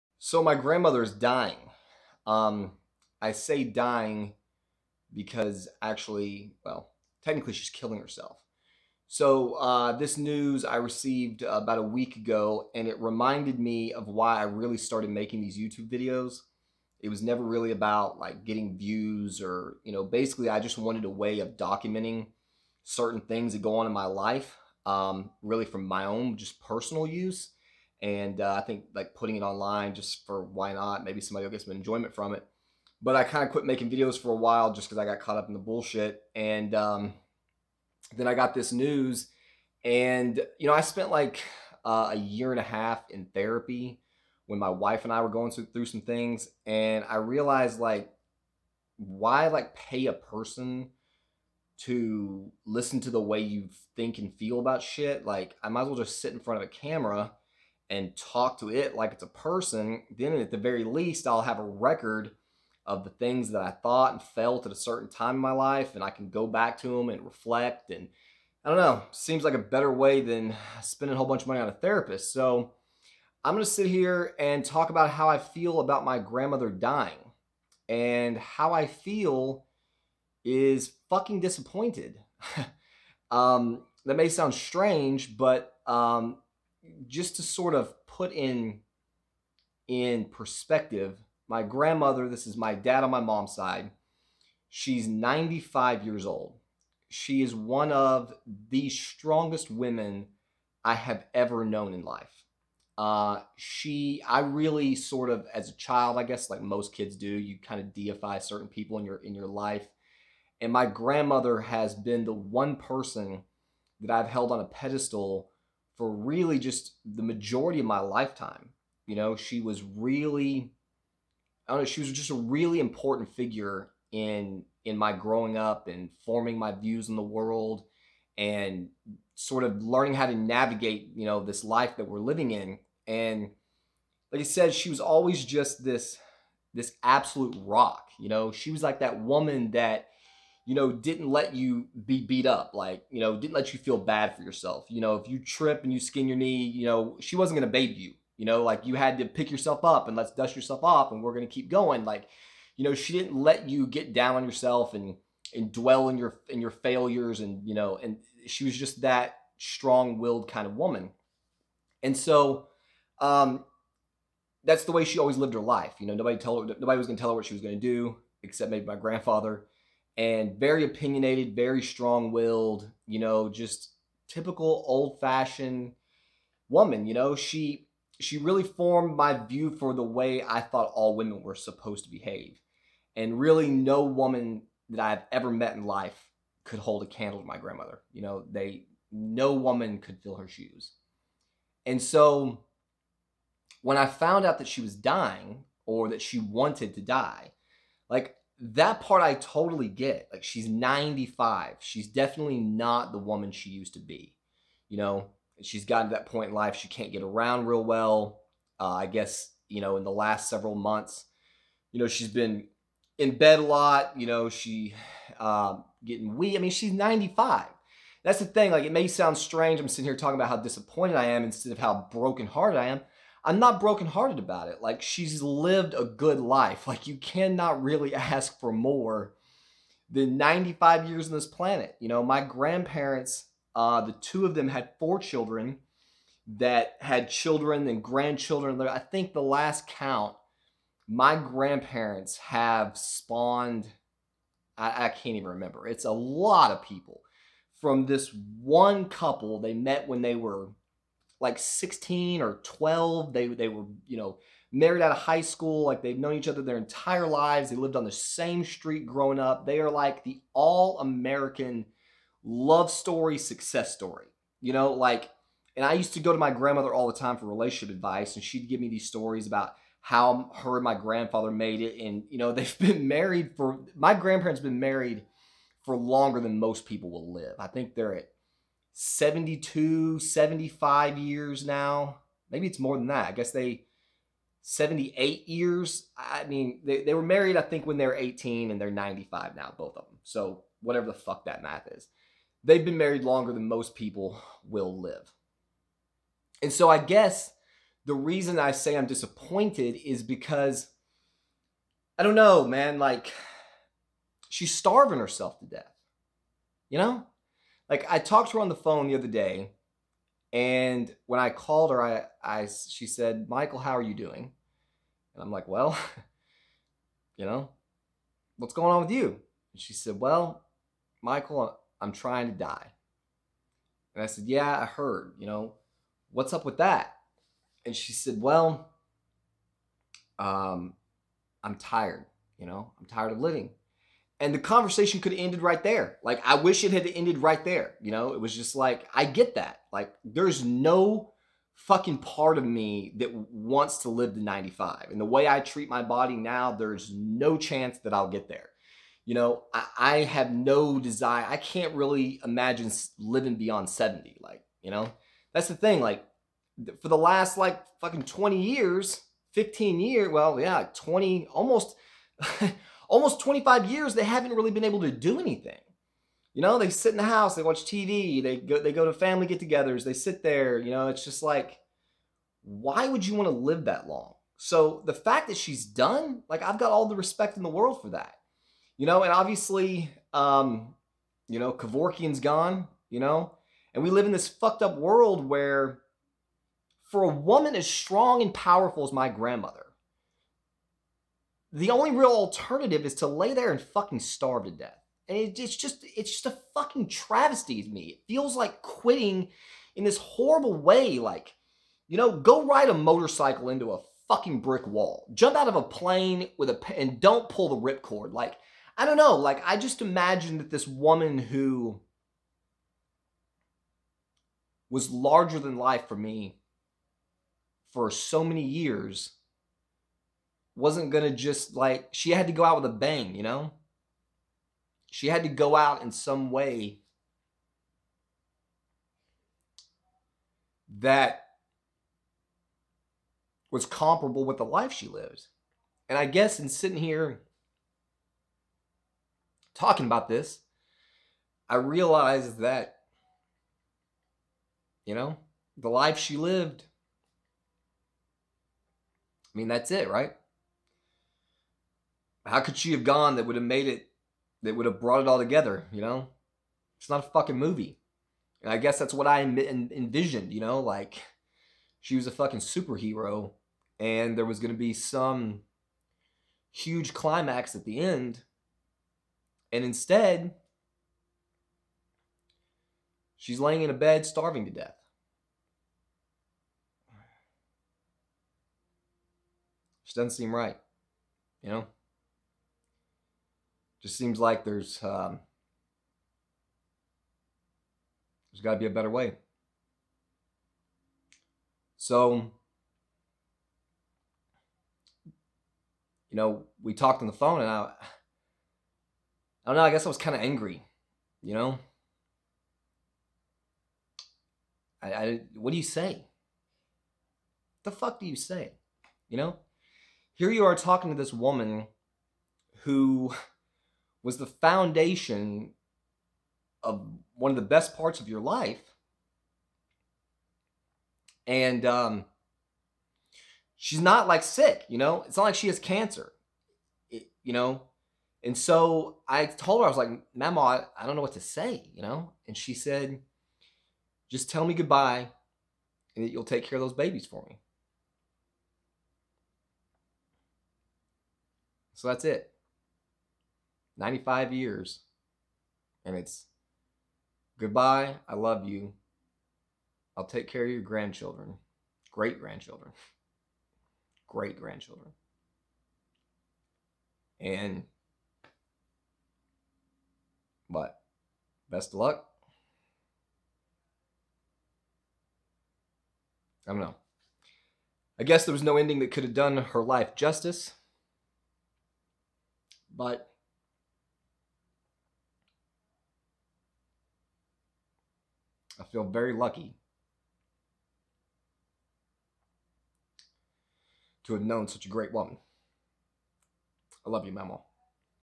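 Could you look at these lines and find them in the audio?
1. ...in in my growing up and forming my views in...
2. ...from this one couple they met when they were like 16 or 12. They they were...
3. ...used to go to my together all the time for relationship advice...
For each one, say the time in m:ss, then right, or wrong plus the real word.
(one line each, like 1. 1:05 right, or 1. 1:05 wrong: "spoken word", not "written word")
1. 2:04 right
2. 4:07 right
3. 4:25 wrong: "grandmother", not "together".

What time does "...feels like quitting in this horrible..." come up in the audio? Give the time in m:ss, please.
6:38.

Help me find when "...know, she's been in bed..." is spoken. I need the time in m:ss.
3:31.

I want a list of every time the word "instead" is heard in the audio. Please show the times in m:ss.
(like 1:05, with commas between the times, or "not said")
3:41, 7:49.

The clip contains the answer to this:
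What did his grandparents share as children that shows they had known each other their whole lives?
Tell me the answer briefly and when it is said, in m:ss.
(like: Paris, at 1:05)
The same street, at 4:18.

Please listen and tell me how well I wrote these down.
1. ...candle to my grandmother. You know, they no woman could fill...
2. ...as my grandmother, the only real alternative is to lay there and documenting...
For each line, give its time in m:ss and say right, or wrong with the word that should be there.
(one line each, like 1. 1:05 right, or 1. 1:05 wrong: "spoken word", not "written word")
1. 3:07 right
2. 6:29 wrong: "fucking", not "documenting".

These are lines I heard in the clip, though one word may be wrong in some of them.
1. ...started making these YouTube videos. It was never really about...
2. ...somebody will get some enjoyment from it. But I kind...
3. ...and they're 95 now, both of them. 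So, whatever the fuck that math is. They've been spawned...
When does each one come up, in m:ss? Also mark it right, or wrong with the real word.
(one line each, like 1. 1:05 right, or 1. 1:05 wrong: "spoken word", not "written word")
1. 0:14 right
2. 0:31 right
3. 4:48 wrong: "married", not "spawned".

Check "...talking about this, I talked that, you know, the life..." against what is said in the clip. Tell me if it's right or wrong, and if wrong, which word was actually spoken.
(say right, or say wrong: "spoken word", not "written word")
wrong: "realized", not "talked".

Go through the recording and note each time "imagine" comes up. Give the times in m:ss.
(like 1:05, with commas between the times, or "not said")
5:52, 6:50.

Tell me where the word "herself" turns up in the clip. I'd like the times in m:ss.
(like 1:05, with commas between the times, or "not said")
0:07, 5:05.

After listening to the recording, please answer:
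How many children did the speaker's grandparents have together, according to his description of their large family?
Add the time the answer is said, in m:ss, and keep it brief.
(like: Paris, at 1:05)
4, at 3:54.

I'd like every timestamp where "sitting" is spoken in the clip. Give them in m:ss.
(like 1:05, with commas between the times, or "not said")
3:39, 7:16.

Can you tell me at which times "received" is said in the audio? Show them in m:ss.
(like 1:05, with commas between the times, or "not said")
0:10.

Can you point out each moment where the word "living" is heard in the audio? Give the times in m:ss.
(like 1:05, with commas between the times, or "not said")
2:12, 5:33, 5:53.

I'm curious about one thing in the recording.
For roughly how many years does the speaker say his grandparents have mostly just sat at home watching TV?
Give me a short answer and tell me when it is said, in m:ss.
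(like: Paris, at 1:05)
Almost 25 years, at 6:03.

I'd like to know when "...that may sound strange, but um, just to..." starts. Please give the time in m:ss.
1:24.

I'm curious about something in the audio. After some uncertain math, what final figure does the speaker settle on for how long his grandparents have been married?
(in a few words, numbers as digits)
78 years.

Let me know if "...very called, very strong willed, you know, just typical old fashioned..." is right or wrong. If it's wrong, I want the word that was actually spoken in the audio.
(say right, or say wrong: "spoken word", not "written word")
wrong: "opinionated", not "called".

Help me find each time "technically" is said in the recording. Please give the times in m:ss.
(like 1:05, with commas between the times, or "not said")
0:07.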